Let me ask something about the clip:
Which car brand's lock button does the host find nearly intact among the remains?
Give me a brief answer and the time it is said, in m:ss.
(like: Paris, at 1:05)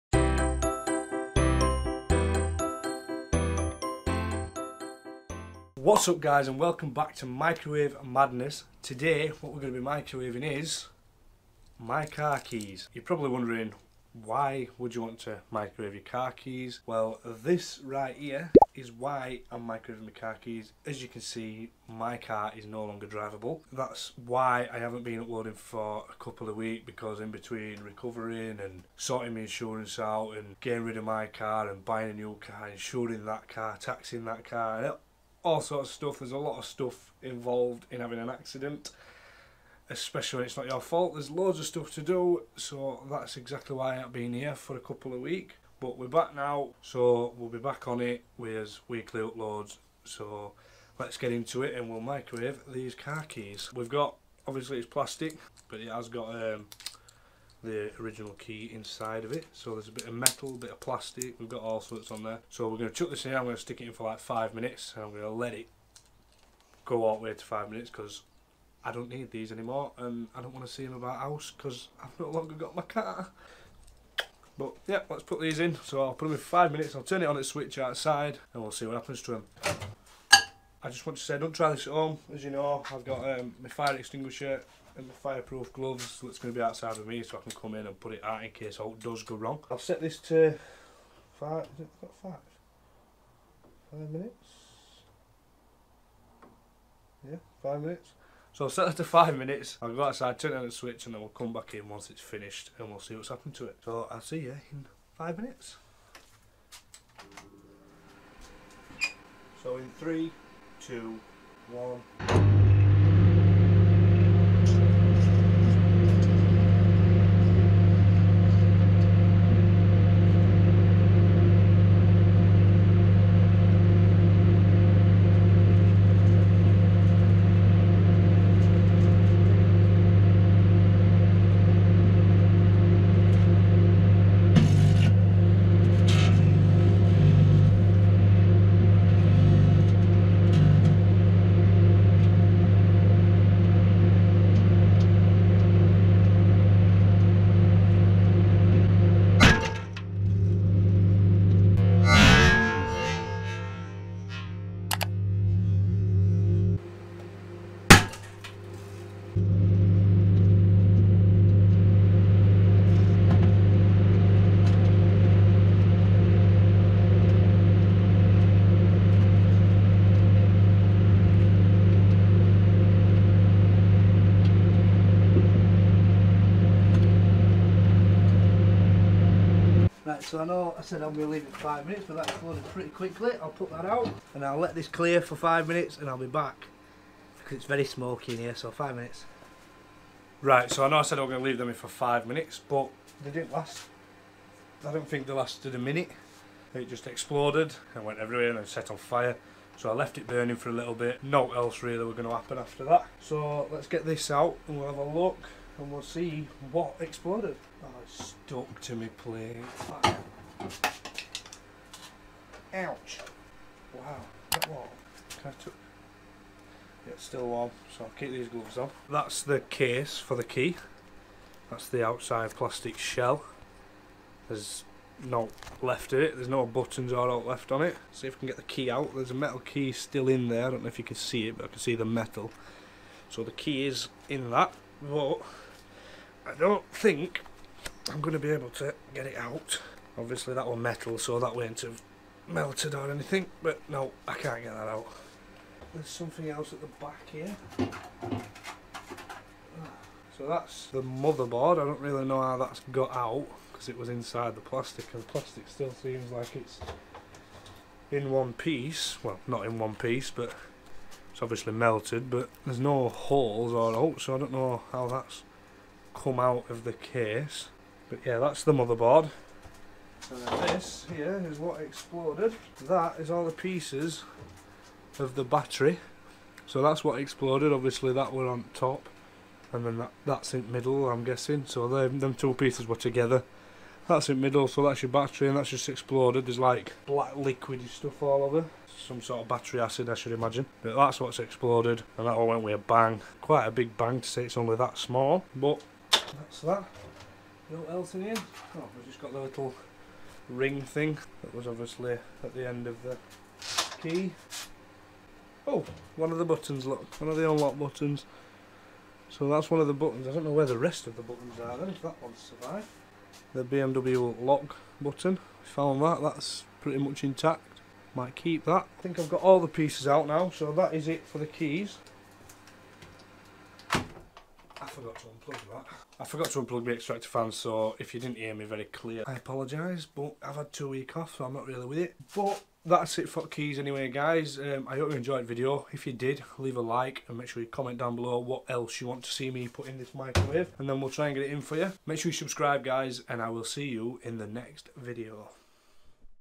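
BMW, at 5:13.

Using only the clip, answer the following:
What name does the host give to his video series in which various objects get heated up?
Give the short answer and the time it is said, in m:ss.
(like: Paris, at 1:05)
Microwave Madness, at 0:07.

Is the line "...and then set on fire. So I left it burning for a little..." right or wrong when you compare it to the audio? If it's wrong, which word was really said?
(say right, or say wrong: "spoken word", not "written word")
right.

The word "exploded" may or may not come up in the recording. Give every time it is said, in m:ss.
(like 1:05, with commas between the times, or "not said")
3:17, 3:26, 4:31, 4:37, 4:45, 4:51.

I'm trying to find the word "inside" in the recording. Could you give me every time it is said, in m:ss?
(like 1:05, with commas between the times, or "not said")
0:58, 4:14.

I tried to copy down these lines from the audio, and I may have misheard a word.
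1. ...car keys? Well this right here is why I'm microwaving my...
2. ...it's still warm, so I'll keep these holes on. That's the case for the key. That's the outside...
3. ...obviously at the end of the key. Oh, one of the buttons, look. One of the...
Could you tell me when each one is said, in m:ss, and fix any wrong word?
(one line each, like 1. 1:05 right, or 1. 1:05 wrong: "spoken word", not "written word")
1. 0:16 right
2. 3:37 wrong: "gloves", not "holes"
3. 5:01 right.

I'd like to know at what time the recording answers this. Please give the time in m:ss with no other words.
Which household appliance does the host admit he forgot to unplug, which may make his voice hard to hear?
5:26.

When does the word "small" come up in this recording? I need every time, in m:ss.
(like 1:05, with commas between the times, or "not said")
4:54.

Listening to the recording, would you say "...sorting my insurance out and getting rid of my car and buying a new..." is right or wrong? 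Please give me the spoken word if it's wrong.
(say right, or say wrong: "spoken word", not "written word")
right.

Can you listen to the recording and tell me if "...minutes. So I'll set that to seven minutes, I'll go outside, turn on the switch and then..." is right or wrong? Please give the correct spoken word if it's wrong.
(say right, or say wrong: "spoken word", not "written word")
wrong: "five", not "seven".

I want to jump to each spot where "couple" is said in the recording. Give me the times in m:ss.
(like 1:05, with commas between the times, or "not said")
0:26, 0:44.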